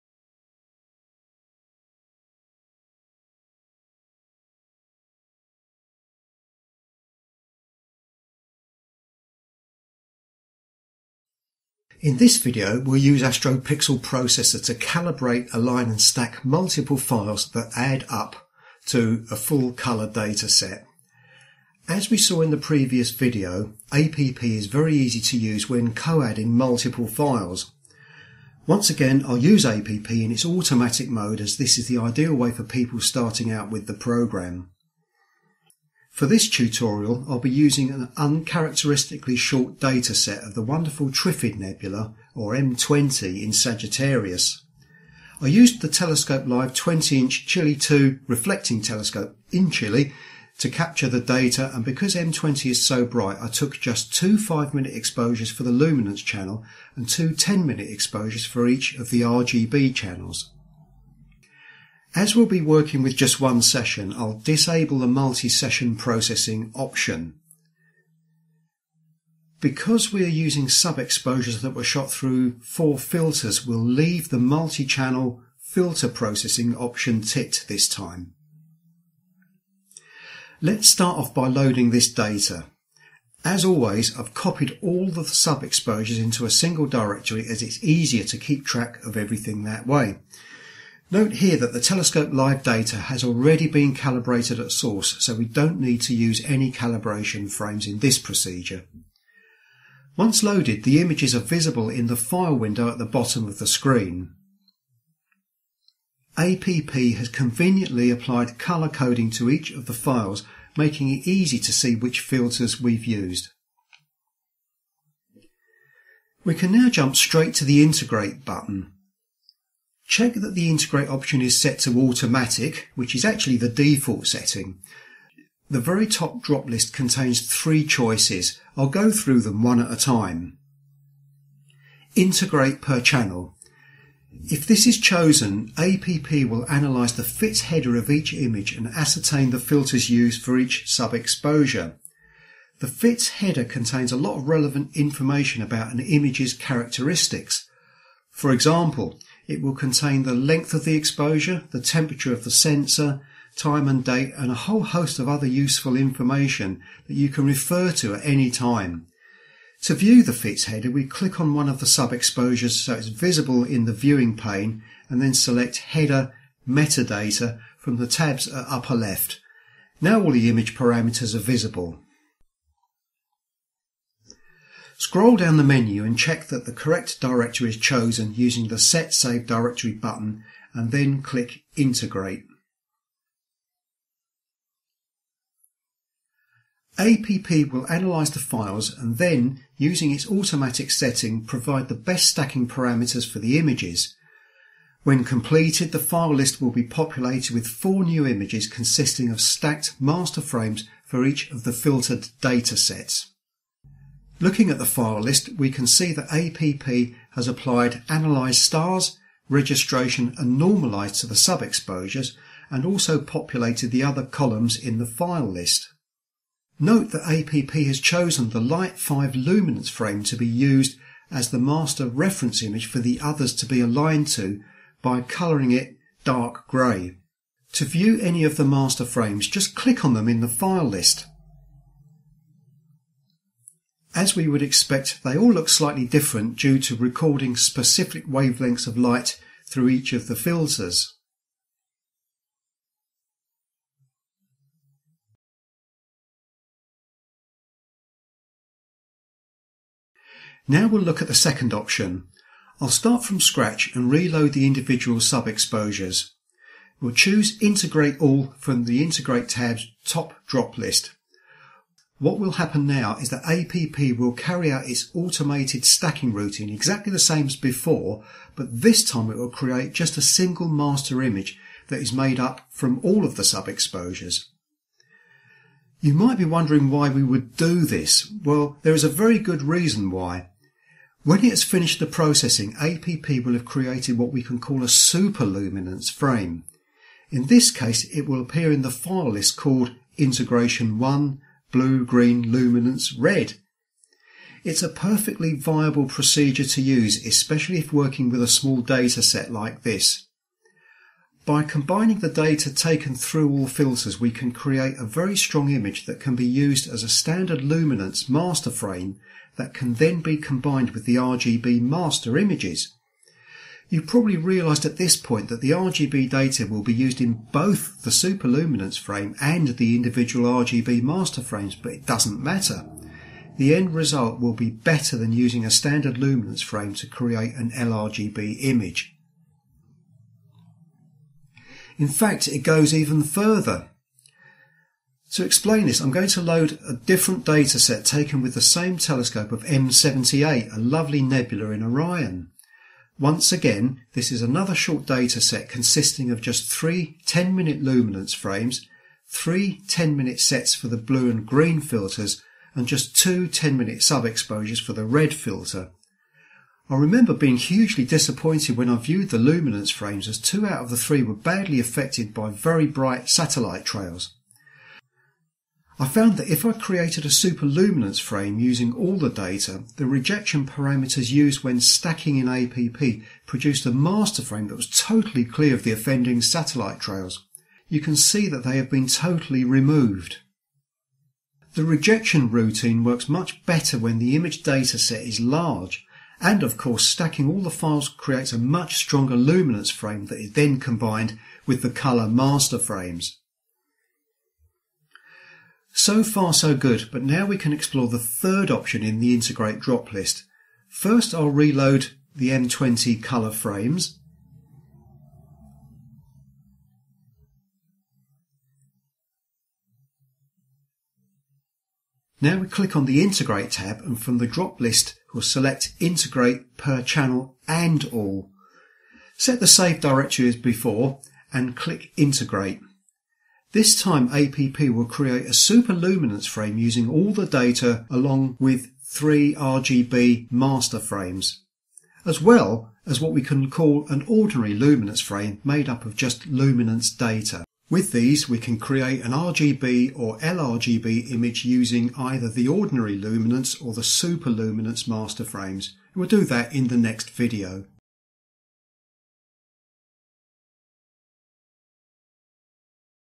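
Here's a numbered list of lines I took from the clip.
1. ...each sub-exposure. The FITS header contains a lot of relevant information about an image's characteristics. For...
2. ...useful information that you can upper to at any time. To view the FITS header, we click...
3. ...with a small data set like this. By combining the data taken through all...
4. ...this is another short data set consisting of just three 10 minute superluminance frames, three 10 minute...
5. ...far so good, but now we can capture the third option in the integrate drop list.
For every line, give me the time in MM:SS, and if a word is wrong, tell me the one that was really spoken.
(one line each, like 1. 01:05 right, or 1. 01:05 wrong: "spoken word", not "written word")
1. 02:20 right
2. 02:35 wrong: "refer", not "upper"
3. 04:58 right
4. 05:44 wrong: "luminance", not "superluminance"
5. 06:36 wrong: "explore", not "capture".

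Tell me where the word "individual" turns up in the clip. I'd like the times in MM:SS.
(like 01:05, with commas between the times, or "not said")
04:14, 05:19.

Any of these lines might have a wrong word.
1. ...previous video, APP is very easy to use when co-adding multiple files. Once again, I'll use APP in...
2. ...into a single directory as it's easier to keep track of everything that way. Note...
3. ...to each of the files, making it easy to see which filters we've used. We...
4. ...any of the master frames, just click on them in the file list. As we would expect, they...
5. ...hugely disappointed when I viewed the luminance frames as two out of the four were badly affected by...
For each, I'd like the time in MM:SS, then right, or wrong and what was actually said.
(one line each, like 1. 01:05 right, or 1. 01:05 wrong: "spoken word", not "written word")
1. 00:22 right
2. 01:26 right
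3. 01:49 right
4. 03:48 right
5. 05:57 wrong: "three", not "four".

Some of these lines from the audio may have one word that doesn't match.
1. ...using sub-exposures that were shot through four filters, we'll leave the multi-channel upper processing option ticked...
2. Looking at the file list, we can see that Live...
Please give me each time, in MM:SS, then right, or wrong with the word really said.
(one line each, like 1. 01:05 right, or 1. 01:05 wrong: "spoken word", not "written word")
1. 01:10 wrong: "filter", not "upper"
2. 03:24 wrong: "APP", not "Live".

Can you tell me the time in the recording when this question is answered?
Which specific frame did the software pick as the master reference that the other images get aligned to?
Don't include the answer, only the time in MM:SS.
03:38.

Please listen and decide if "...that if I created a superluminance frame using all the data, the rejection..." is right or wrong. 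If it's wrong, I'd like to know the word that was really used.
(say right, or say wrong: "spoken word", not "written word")
right.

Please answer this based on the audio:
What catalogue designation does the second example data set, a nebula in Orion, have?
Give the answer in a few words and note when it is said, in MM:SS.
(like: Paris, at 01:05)
M78, at 05:39.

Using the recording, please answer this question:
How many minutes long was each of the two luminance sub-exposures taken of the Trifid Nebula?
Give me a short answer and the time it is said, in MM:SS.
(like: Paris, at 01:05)
5, at 00:54.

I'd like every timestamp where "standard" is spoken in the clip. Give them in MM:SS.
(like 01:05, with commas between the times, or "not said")
05:07, 05:25.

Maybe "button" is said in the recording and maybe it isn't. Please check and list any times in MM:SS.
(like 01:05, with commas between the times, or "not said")
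01:58, 02:59.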